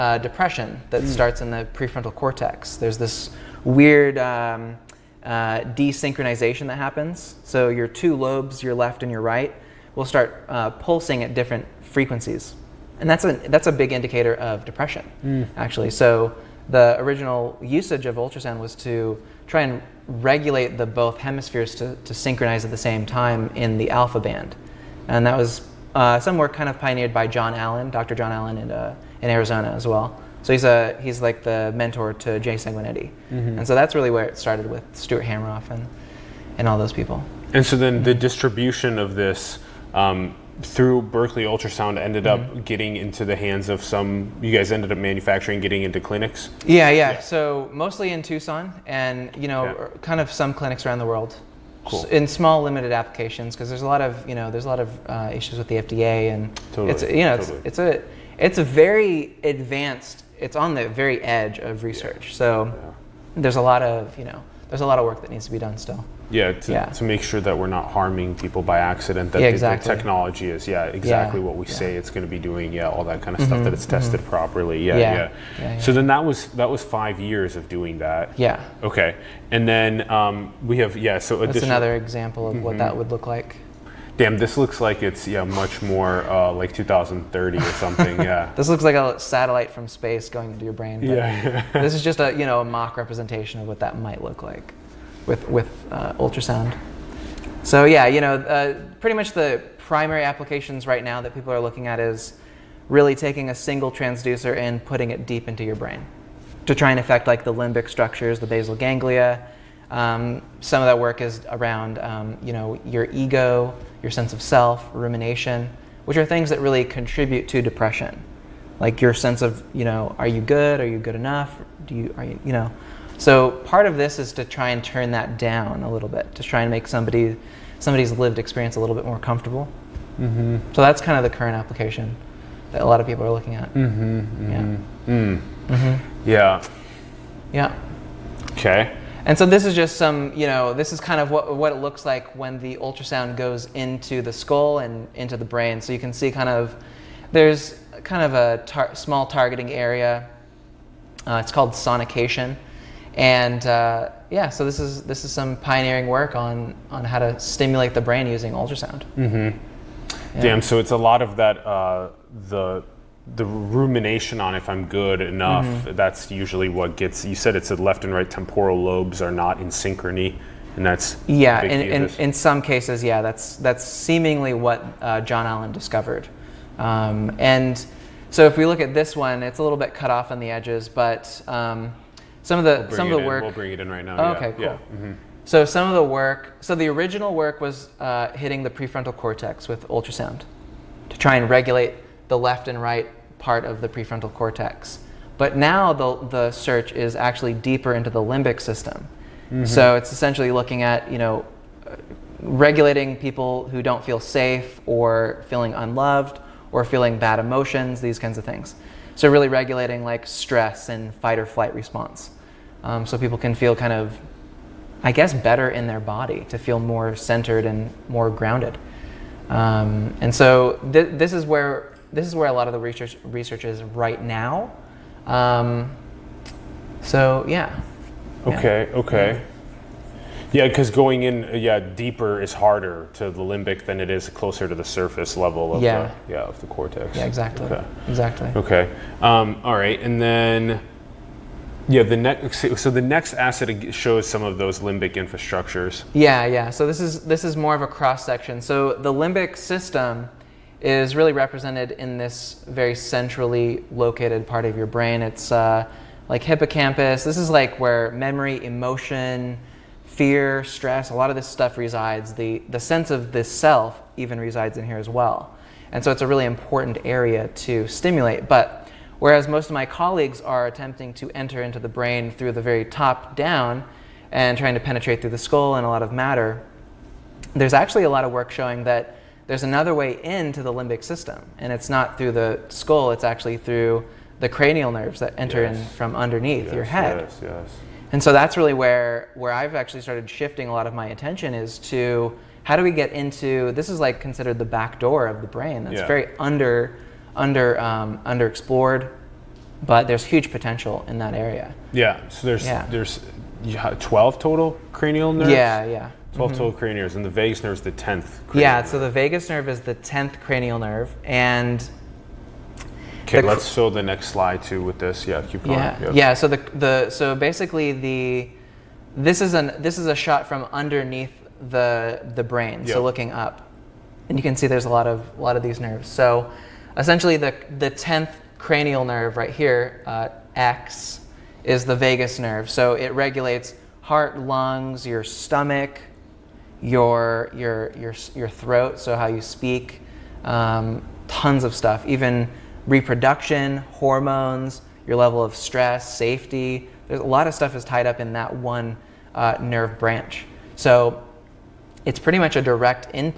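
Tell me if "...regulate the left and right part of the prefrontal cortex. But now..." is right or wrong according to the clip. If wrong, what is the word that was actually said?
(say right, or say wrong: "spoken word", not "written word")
right.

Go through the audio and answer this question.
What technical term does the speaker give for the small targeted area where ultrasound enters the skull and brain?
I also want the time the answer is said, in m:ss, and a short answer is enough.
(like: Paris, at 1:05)
sonication, at 2:31.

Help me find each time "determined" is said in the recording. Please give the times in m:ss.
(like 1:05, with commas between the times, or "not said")
not said.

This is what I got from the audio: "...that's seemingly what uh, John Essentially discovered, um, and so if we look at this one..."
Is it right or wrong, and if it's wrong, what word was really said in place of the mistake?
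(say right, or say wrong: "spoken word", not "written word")
wrong: "Allen", not "Essentially".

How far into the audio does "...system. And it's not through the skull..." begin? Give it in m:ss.
4:41.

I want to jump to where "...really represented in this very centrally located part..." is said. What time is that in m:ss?
4:11.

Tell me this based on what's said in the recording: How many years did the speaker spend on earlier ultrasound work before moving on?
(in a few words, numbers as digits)
5.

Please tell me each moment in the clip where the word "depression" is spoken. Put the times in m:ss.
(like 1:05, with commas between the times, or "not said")
0:00, 0:14, 1:57.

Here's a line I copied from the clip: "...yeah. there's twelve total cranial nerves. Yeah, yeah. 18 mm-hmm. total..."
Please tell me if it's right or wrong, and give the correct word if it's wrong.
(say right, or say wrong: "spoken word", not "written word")
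wrong: "12", not "18".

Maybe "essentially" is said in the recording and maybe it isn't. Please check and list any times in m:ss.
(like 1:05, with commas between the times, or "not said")
3:20, 5:26.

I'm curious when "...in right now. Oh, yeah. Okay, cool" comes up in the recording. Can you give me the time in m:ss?
3:03.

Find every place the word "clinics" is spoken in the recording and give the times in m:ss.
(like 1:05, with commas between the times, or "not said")
0:45, 0:50.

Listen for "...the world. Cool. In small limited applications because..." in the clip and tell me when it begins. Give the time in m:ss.
0:50.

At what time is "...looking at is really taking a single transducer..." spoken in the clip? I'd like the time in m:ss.
1:41.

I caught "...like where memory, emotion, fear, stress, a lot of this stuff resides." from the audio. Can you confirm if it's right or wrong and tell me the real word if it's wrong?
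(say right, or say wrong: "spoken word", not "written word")
right.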